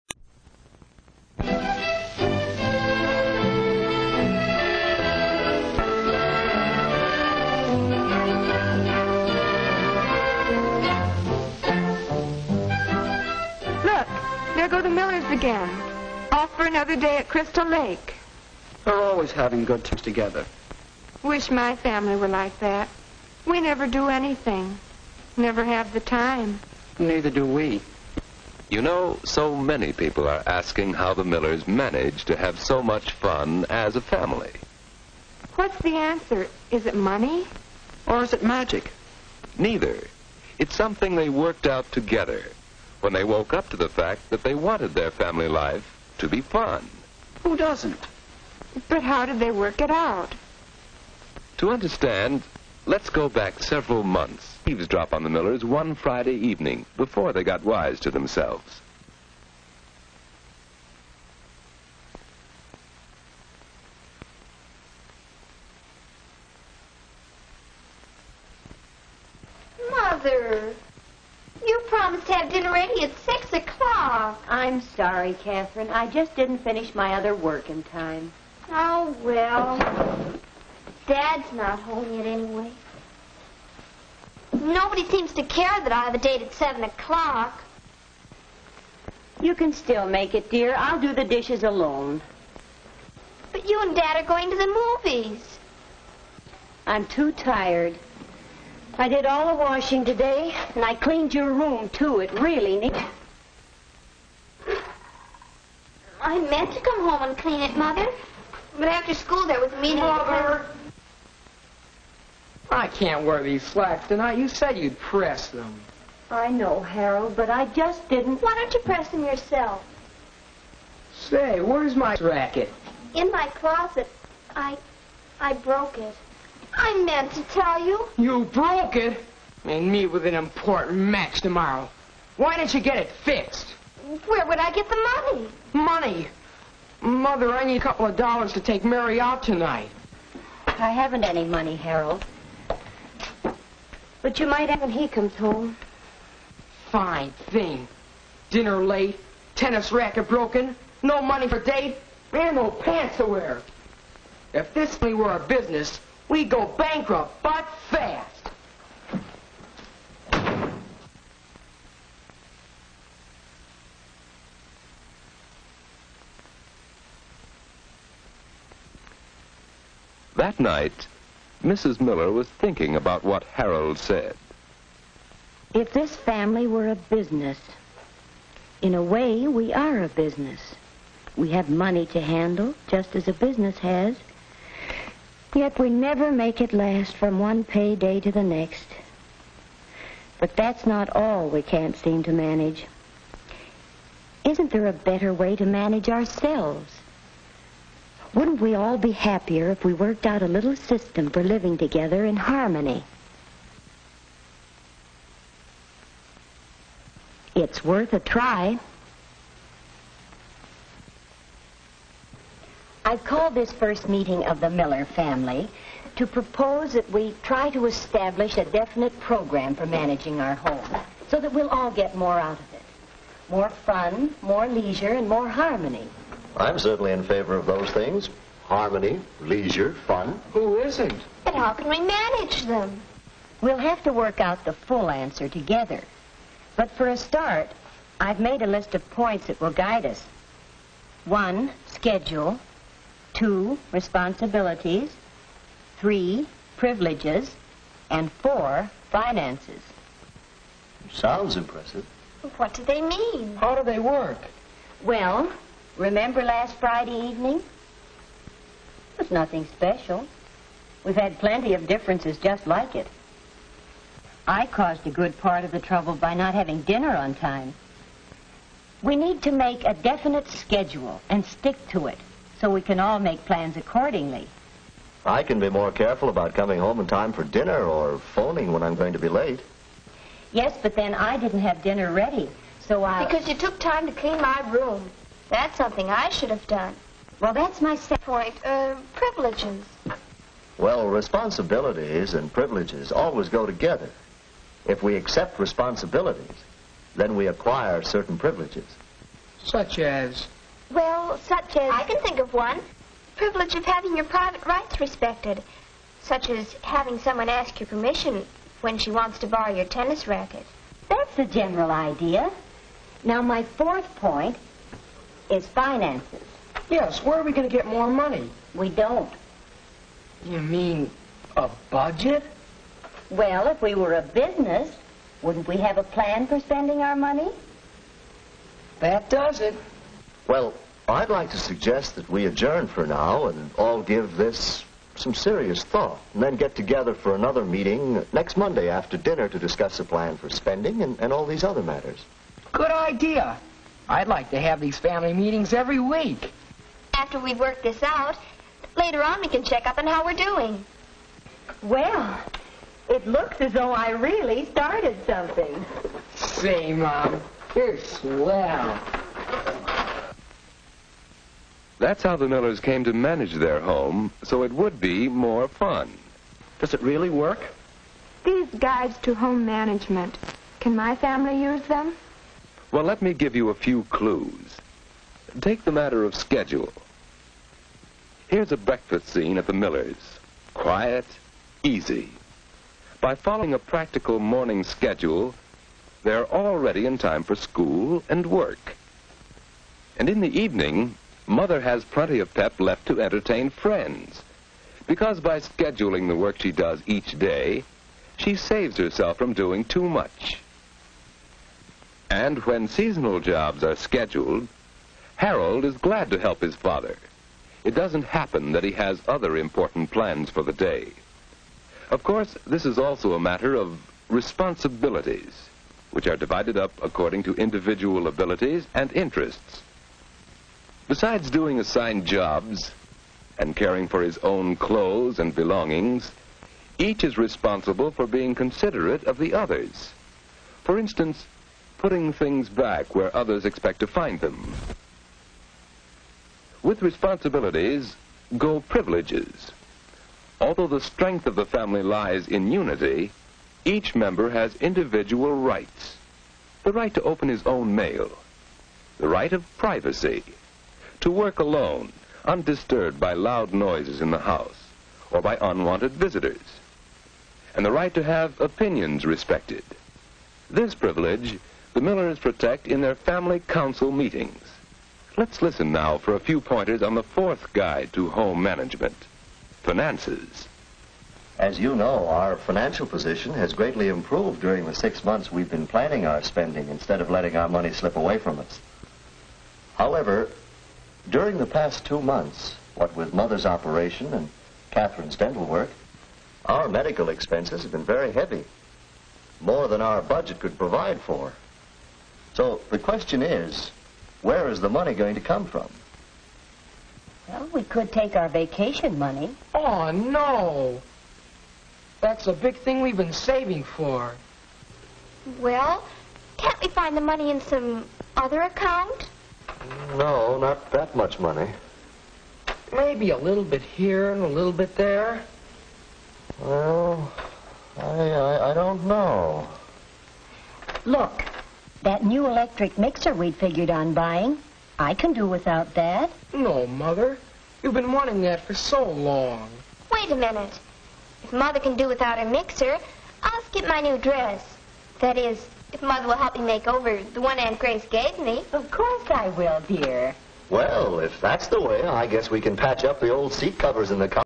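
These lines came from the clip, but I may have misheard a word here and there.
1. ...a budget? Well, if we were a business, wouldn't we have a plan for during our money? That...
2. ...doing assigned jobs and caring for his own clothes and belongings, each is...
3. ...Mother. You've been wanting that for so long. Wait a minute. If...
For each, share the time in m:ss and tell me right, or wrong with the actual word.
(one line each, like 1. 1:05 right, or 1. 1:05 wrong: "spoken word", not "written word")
1. 5:21 wrong: "spending", not "during"
2. 7:01 right
3. 8:46 right.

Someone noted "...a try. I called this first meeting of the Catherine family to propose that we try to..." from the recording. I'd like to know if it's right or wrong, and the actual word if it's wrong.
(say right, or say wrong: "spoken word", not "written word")
wrong: "Miller", not "Catherine".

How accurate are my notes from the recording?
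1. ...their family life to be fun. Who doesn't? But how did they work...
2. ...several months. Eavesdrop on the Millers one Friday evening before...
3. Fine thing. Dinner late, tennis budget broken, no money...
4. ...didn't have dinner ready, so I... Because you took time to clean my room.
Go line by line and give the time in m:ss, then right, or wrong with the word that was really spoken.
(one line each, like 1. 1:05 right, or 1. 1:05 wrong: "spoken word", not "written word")
1. 0:44 right
2. 0:53 right
3. 2:26 wrong: "racket", not "budget"
4. 4:41 right.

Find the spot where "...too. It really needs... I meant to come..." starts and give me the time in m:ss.
1:41.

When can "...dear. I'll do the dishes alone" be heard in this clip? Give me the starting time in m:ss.
1:30.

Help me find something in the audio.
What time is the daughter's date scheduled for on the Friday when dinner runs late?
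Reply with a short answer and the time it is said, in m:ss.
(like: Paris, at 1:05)
7 o'clock, at 1:26.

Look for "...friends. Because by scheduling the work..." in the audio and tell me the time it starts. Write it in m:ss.
6:33.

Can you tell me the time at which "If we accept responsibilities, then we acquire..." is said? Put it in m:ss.
4:54.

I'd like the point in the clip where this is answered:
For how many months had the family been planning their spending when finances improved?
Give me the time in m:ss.
7:54.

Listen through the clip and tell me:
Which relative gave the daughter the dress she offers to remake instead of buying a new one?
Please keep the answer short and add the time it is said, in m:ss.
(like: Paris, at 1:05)
Aunt Grace, at 8:57.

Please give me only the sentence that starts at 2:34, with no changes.
If this money were a business, we go bankrupt, but fast.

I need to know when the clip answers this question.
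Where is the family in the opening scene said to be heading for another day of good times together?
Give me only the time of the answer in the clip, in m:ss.
0:17.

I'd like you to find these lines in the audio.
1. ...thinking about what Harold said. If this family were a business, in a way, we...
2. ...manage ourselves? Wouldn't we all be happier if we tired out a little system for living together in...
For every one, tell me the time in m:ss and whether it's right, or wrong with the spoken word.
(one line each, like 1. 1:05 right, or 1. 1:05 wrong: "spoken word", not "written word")
1. 2:52 right
2. 3:15 wrong: "worked", not "tired".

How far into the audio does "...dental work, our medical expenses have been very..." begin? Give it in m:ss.
8:05.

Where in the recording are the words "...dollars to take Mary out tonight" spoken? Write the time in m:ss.
2:18.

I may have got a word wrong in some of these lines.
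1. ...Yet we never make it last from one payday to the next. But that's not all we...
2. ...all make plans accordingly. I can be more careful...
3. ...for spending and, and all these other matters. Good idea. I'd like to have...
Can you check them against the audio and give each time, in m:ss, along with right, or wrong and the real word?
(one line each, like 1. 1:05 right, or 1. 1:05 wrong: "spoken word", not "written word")
1. 3:05 right
2. 4:32 right
3. 5:40 right.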